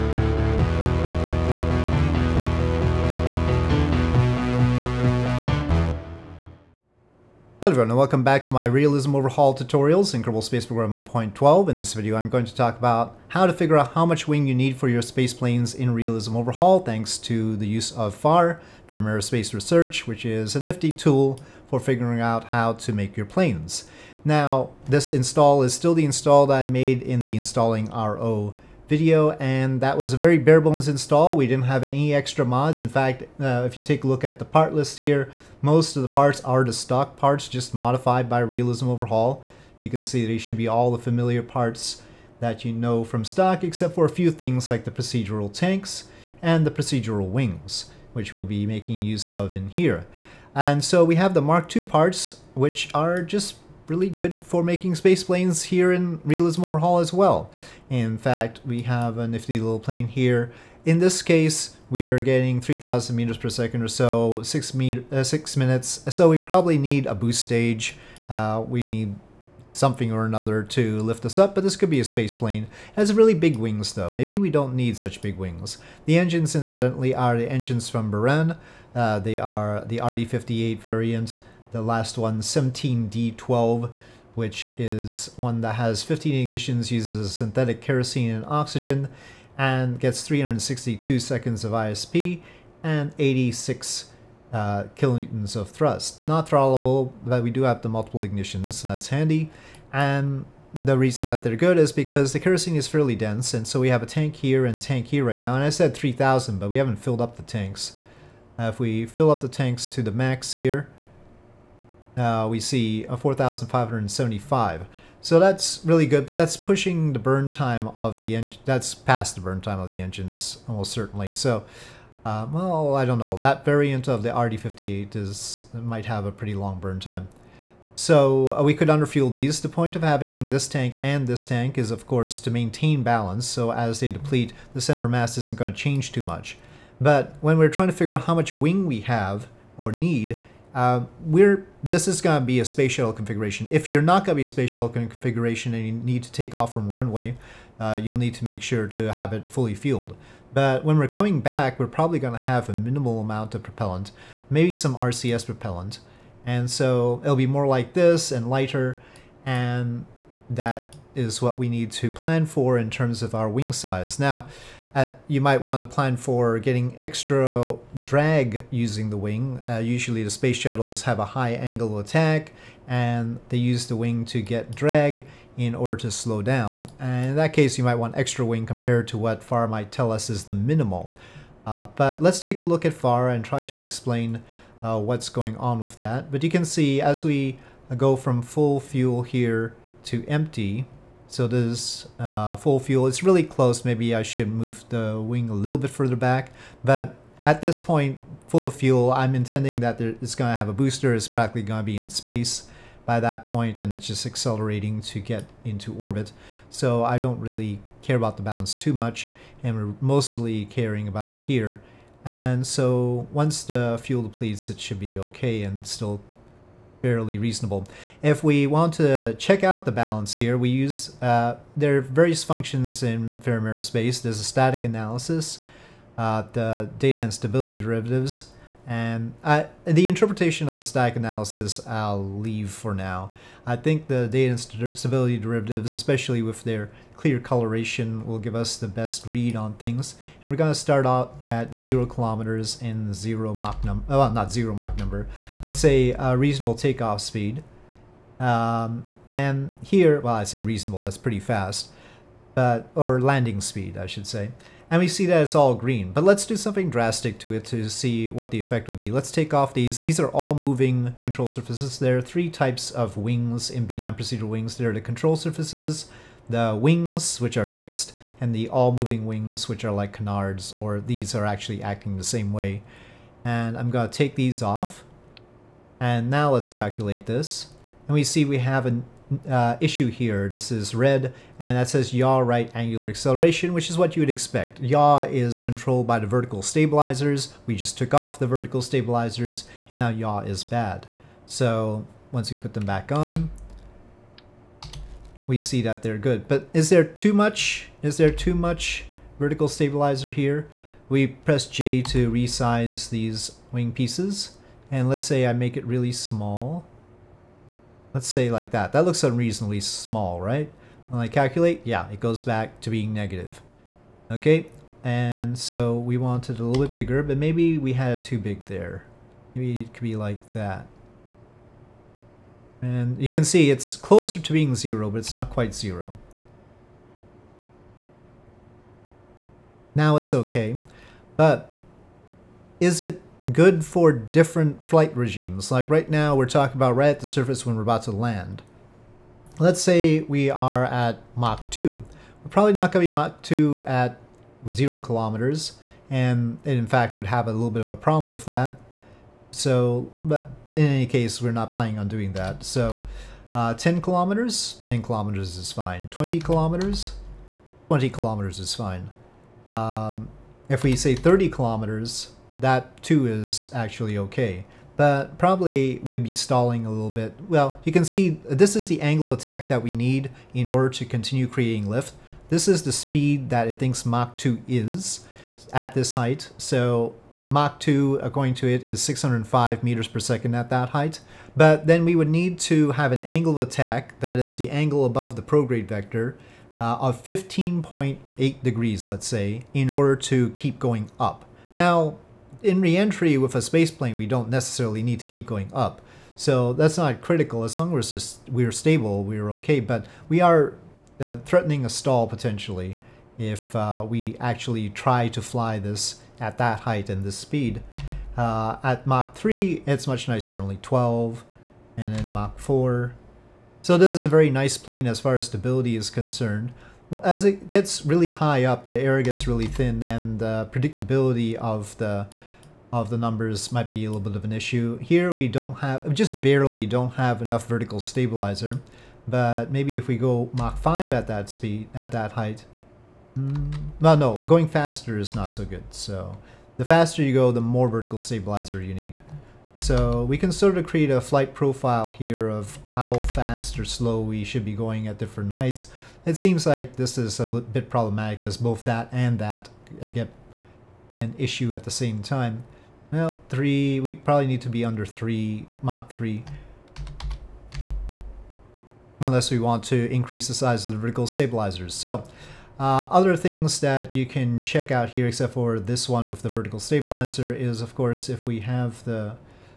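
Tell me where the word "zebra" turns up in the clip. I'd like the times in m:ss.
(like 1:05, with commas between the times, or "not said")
not said.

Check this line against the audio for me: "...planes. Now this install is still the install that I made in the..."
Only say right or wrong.
right.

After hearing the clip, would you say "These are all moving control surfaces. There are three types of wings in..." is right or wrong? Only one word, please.
right.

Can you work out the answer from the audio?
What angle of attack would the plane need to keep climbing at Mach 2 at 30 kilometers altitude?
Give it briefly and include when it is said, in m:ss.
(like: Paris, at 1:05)
15.8 degrees, at 6:27.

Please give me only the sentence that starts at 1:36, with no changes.
Not throttleable, but we do have the multiple ignitions, so that's handy.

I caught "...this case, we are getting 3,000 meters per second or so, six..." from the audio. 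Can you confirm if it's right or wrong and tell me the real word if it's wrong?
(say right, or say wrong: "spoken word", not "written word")
right.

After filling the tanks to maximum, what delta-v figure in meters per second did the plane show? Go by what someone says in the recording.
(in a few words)
4,575.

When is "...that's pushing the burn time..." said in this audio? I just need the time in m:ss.
1:56.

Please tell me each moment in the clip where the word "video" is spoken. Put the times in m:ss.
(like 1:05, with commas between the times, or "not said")
0:11, 0:28.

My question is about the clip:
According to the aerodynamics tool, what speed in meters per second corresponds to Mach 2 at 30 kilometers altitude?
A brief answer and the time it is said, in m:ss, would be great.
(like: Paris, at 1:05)
605 meters per second, at 6:19.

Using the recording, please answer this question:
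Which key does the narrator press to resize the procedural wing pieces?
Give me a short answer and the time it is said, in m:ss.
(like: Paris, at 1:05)
J, at 5:01.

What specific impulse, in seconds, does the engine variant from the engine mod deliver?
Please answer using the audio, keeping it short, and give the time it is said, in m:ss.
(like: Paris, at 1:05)
362 seconds, at 1:30.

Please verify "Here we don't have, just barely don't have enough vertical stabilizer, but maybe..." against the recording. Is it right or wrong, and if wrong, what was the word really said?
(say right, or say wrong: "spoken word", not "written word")
right.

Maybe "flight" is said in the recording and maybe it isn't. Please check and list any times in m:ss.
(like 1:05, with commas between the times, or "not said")
5:34, 7:21.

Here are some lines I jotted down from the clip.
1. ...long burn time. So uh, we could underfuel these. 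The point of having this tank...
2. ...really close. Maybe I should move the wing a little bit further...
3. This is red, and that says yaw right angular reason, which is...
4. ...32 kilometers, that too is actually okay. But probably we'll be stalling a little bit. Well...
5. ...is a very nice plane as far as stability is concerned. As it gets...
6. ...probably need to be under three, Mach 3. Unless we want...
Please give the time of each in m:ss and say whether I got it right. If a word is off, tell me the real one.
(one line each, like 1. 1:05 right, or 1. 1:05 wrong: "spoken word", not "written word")
1. 2:06 right
2. 3:13 right
3. 4:40 wrong: "acceleration", not "reason"
4. 6:01 wrong: "30", not "32"
5. 6:54 right
6. 7:34 right.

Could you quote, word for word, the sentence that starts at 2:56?
And in that case, you might want extra wing compared to what FAR might tell us is the minimal.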